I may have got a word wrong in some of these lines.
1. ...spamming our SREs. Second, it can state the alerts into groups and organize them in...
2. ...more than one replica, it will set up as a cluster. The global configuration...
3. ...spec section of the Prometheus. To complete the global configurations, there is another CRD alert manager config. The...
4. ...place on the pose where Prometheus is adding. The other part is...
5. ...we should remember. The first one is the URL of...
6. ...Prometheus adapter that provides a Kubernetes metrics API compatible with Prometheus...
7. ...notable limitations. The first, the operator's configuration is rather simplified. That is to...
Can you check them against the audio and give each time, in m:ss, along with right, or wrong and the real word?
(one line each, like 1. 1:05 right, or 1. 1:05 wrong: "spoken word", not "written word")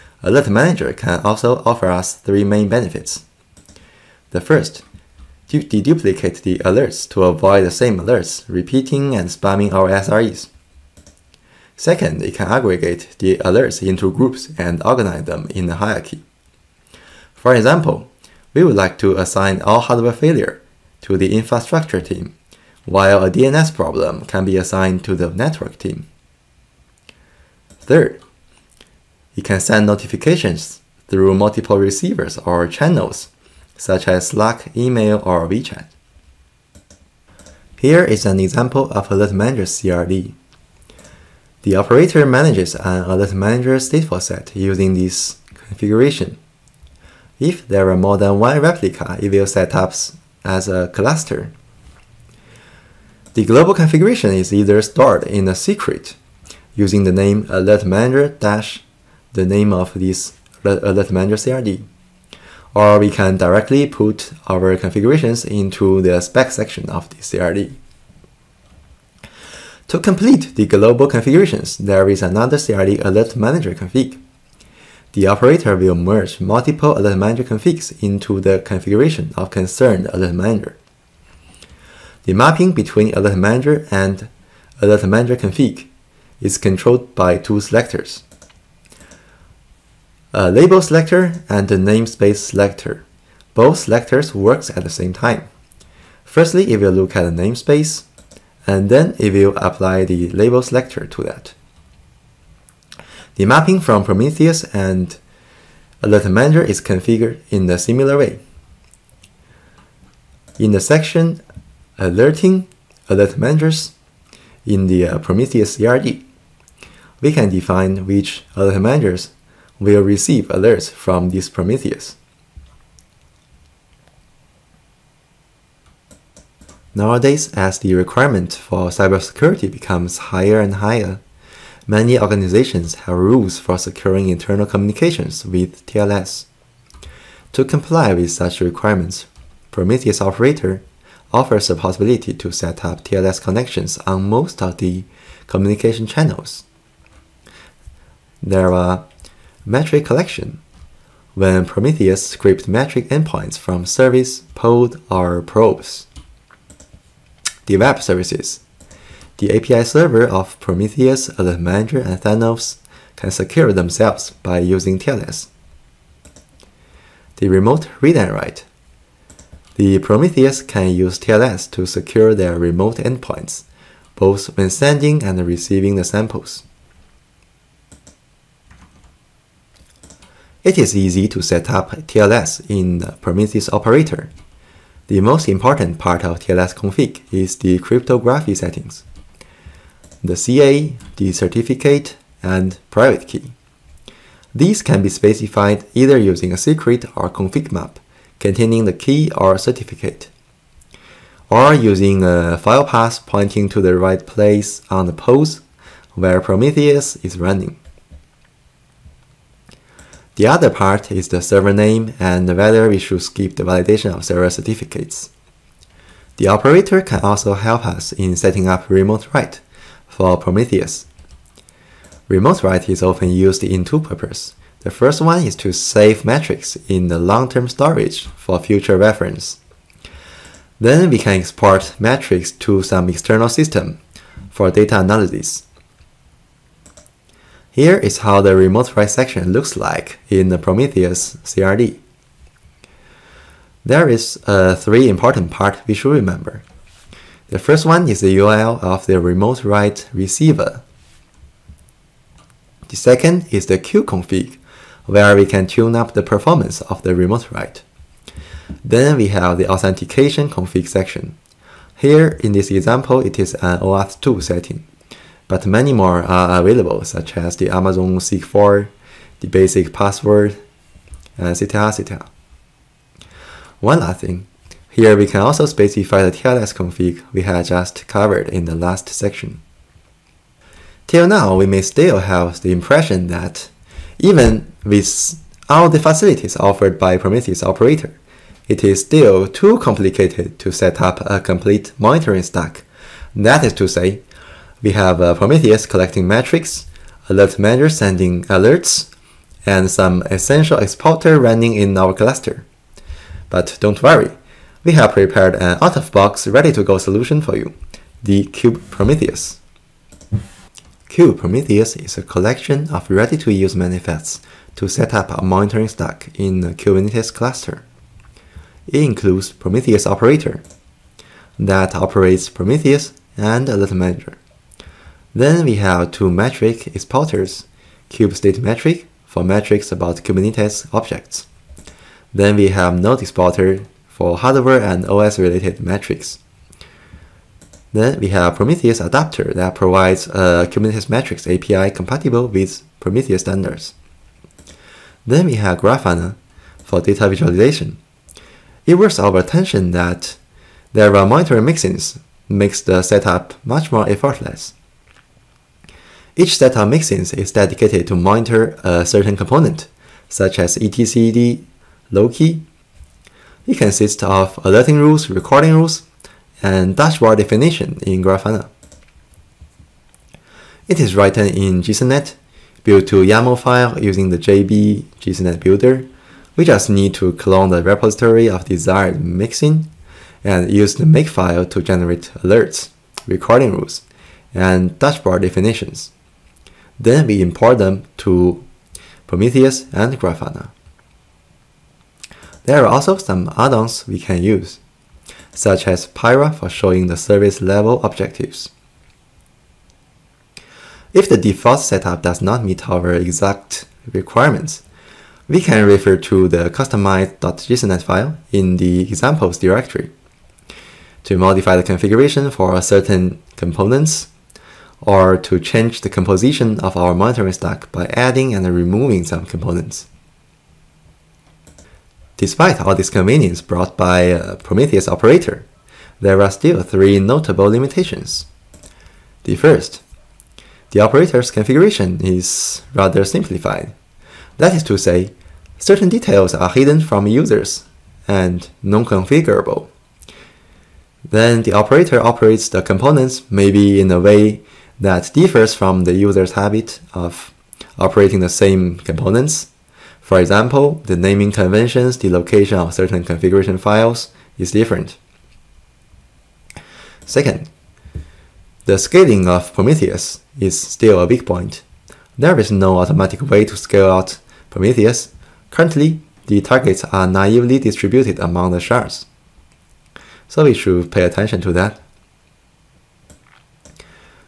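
1. 0:09 wrong: "aggregate", not "state"
2. 0:47 right
3. 1:06 wrong: "CRD", not "Prometheus"
4. 3:24 wrong: "running", not "adding"
5. 4:05 right
6. 5:38 right
7. 7:07 right.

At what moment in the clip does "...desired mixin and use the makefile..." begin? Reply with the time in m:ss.
6:18.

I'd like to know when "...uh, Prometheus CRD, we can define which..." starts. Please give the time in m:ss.
1:55.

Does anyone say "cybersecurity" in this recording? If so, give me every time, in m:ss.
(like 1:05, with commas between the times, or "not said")
2:08.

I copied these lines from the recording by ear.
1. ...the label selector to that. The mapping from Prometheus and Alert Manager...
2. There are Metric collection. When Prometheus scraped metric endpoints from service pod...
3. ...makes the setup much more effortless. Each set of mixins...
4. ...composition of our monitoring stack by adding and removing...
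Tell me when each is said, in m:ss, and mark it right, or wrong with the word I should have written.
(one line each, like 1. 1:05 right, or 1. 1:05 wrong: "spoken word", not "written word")
1. 1:40 right
2. 2:28 right
3. 5:52 right
4. 6:56 right.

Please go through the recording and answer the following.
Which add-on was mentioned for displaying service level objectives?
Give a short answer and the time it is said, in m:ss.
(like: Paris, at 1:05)
Pyrra, at 6:36.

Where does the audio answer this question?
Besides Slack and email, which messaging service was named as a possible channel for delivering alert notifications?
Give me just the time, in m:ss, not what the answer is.
0:35.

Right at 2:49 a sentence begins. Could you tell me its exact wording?
The Prometheus can use TLS to secure their remote endpoints, both when sending and receiving the samples.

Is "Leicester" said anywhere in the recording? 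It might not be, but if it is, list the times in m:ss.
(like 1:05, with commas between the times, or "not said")
not said.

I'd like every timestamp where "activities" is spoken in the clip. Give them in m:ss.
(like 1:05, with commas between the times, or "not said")
not said.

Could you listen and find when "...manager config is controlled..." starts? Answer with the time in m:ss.
1:25.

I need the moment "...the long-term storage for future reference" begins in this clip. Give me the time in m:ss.
3:47.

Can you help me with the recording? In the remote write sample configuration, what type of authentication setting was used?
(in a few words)
OAuth2.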